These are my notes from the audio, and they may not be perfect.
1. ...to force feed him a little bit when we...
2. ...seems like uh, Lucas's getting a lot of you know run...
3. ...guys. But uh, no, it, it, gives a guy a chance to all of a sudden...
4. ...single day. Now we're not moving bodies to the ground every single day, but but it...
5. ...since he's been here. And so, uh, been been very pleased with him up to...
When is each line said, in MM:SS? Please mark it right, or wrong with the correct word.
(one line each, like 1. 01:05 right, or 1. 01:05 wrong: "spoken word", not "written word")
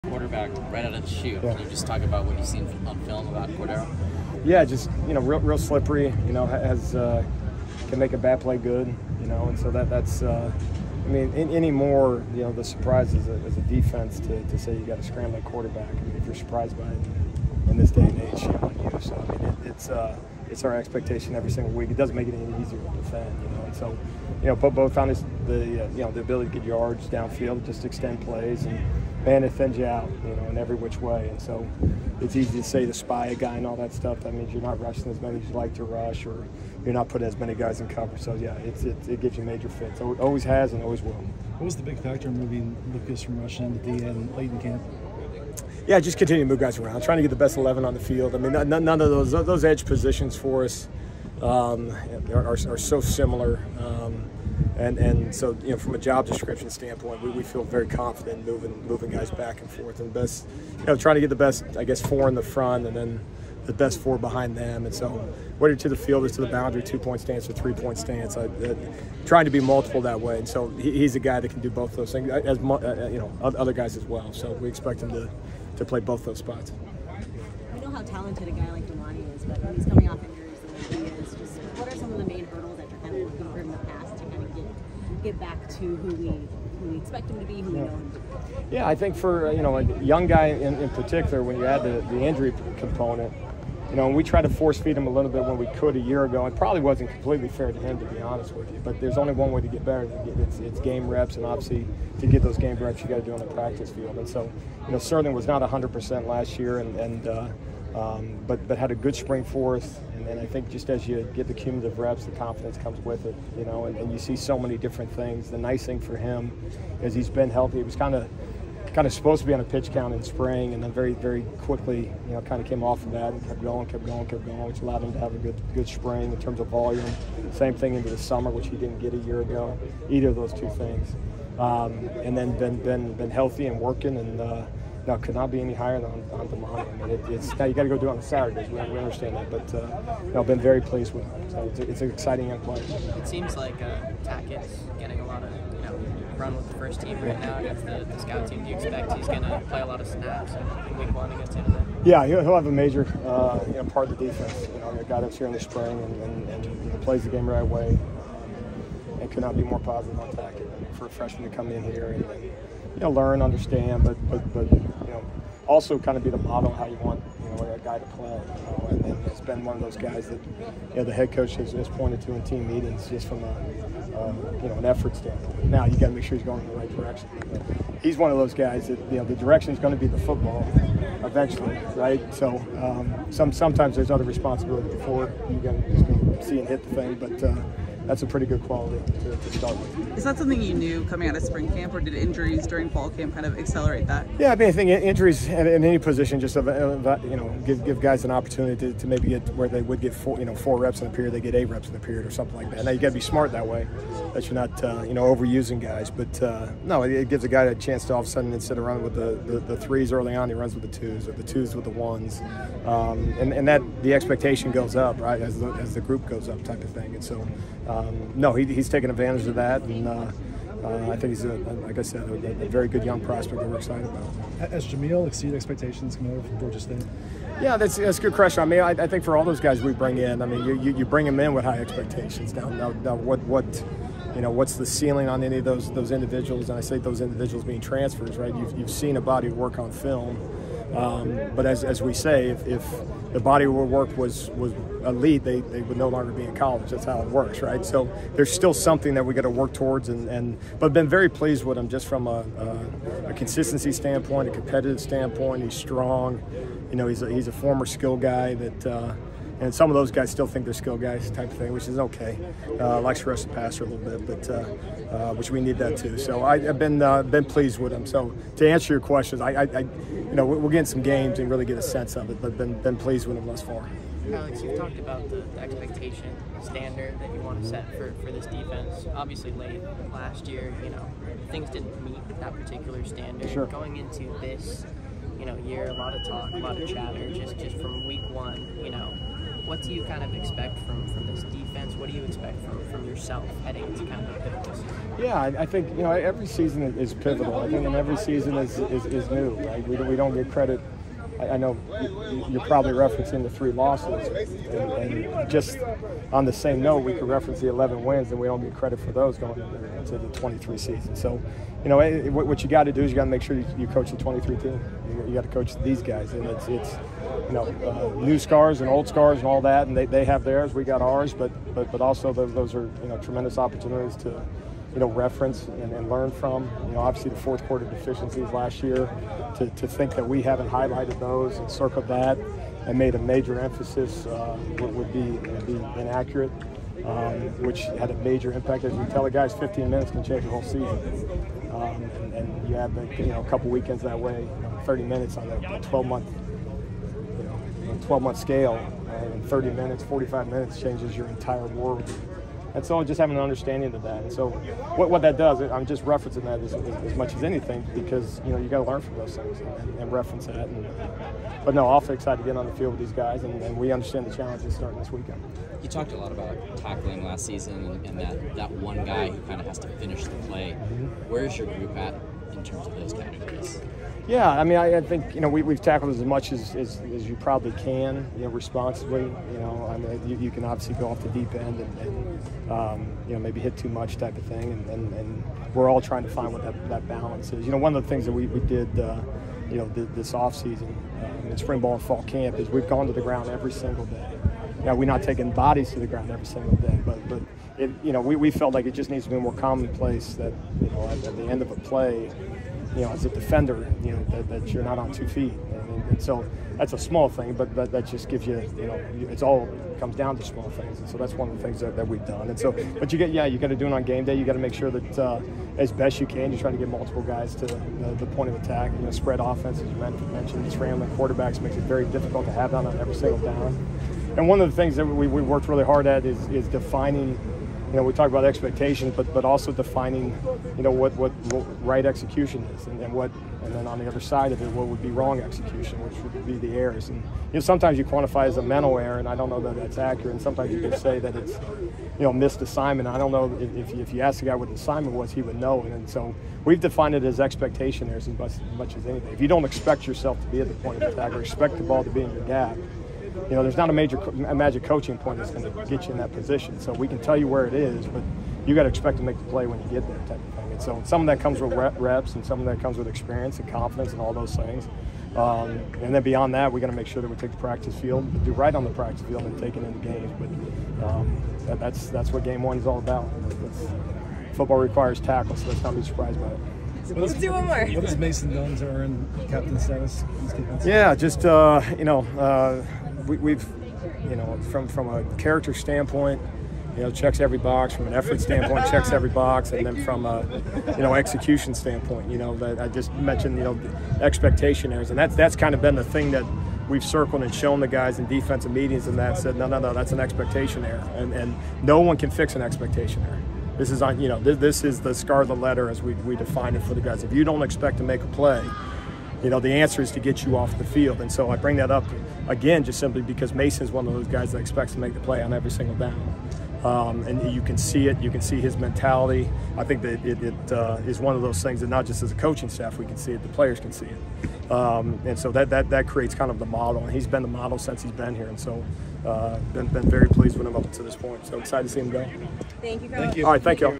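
1. 01:34 right
2. 02:23 wrong: "Tackett", not "Lucas"
3. 03:25 right
4. 06:33 wrong: "taking", not "moving"
5. 08:47 right.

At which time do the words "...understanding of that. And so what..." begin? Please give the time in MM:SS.
05:53.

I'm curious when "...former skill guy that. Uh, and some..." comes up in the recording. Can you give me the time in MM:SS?
04:17.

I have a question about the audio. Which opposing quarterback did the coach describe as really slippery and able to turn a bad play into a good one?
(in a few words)
Cordeiro.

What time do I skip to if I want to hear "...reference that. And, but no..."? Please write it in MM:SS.
06:00.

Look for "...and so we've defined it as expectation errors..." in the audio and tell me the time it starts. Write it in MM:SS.
07:25.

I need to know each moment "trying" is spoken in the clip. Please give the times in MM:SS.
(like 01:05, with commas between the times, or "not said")
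00:47, 01:00, 01:09, 06:26.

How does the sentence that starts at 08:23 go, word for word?
This is on, you know, this, this is the the letter as we we define it for the guys.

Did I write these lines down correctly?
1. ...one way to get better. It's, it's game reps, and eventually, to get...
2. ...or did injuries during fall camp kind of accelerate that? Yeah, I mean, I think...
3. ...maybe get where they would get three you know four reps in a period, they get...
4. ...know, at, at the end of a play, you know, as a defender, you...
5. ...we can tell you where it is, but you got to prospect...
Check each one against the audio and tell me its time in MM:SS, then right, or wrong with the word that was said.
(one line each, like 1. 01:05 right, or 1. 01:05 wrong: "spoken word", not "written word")
1. 01:39 wrong: "obviously", not "eventually"
2. 03:11 right
3. 03:19 wrong: "four", not "three"
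4. 06:40 right
5. 07:36 wrong: "expect", not "prospect".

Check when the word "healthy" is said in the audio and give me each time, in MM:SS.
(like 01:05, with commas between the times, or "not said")
01:57, 02:13.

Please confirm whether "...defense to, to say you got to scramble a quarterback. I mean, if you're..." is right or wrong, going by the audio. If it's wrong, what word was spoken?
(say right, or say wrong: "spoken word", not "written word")
right.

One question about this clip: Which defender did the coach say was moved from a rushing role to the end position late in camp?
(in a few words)
Lucas.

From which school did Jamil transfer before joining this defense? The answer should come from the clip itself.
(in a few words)
Georgia State.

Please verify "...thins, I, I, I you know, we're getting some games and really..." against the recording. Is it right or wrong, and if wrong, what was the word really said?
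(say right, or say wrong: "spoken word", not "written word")
wrong: "questions", not "thins".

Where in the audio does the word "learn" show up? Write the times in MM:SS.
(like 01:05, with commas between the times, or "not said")
02:43, 05:26, 05:58.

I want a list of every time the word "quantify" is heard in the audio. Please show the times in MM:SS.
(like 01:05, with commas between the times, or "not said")
07:18.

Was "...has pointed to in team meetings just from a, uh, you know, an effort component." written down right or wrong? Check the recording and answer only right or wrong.
wrong.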